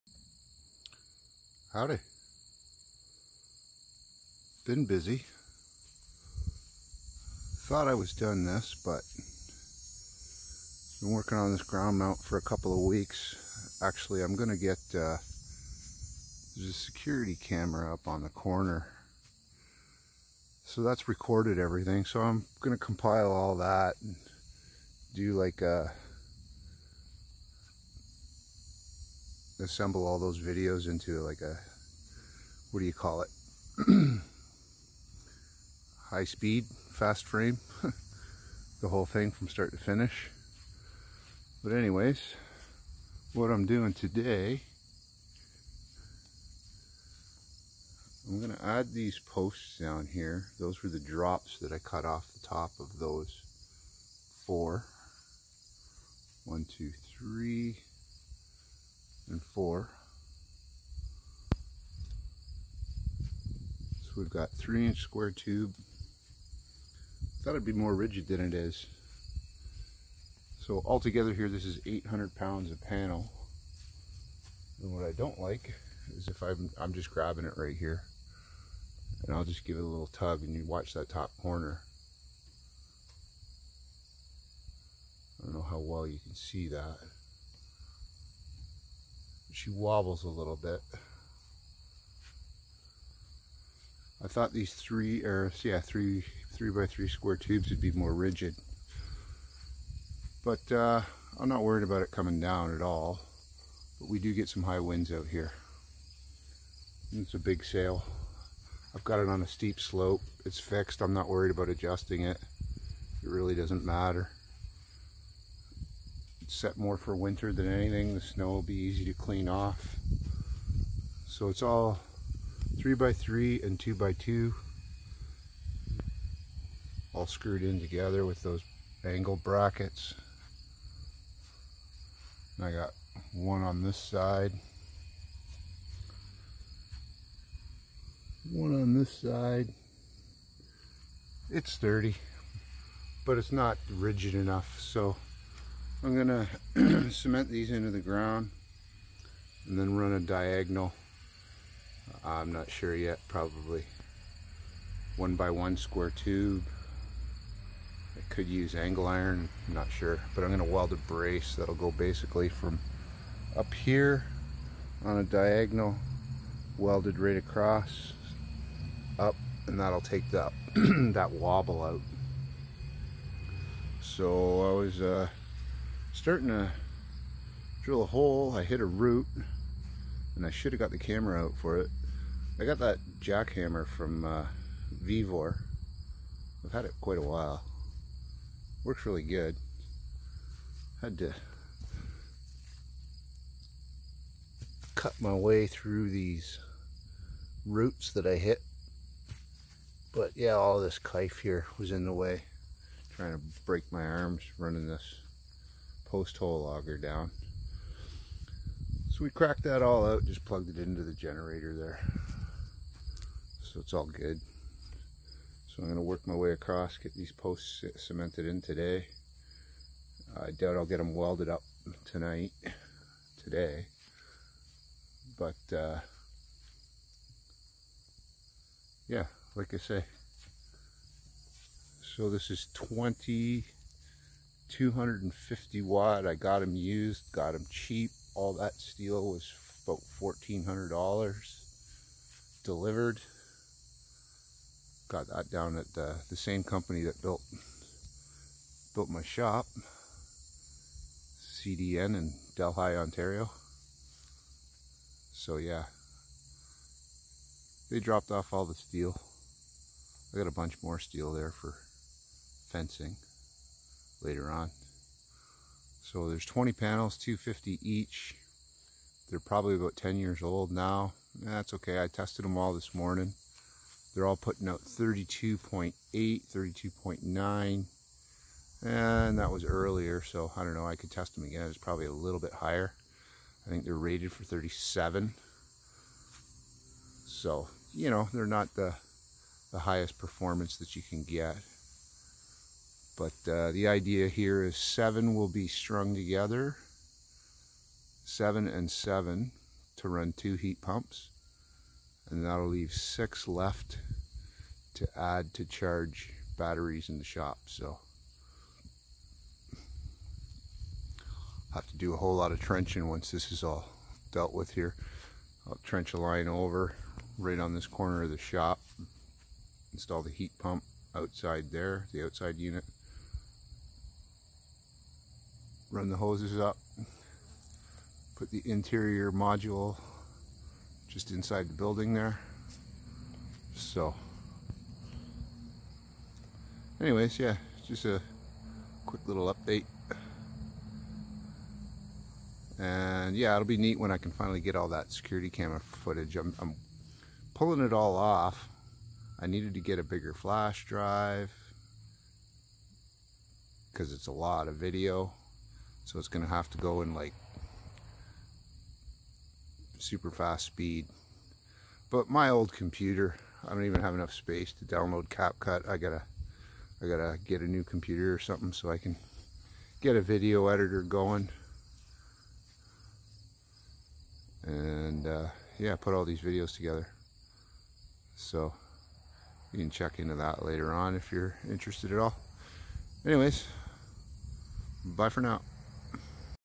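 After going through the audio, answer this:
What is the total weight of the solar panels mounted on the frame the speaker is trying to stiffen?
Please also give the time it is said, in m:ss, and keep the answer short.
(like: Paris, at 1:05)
800 pounds, at 1:11.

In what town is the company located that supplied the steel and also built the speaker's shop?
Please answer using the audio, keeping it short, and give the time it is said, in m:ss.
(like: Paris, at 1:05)
Delhi, Ontario, at 4:12.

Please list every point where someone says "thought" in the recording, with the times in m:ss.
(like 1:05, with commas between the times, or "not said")
0:07, 1:07, 1:34.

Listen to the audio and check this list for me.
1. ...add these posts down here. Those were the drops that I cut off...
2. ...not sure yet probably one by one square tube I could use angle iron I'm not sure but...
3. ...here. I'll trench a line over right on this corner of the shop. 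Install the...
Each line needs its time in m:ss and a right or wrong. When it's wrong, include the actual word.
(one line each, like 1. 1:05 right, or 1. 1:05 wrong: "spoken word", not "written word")
1. 0:48 right
2. 2:32 right
3. 5:14 right.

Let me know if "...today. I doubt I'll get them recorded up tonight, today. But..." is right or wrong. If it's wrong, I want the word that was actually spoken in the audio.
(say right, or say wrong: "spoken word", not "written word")
wrong: "welded", not "recorded".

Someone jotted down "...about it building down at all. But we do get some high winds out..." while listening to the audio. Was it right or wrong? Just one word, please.
wrong.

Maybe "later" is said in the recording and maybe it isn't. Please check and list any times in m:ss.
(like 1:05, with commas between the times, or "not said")
4:24, 6:20.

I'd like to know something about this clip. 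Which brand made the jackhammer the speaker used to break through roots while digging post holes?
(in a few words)
Vevor.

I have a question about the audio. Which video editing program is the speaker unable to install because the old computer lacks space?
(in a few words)
CapCut.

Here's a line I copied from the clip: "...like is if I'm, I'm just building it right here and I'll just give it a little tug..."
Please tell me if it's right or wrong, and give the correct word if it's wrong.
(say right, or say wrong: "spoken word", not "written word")
wrong: "grabbing", not "building".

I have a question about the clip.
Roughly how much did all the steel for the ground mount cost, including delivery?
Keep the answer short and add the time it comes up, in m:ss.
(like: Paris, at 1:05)
$1,400, at 4:00.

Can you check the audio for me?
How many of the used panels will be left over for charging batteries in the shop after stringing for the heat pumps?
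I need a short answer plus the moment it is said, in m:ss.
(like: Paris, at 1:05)
6, at 5:02.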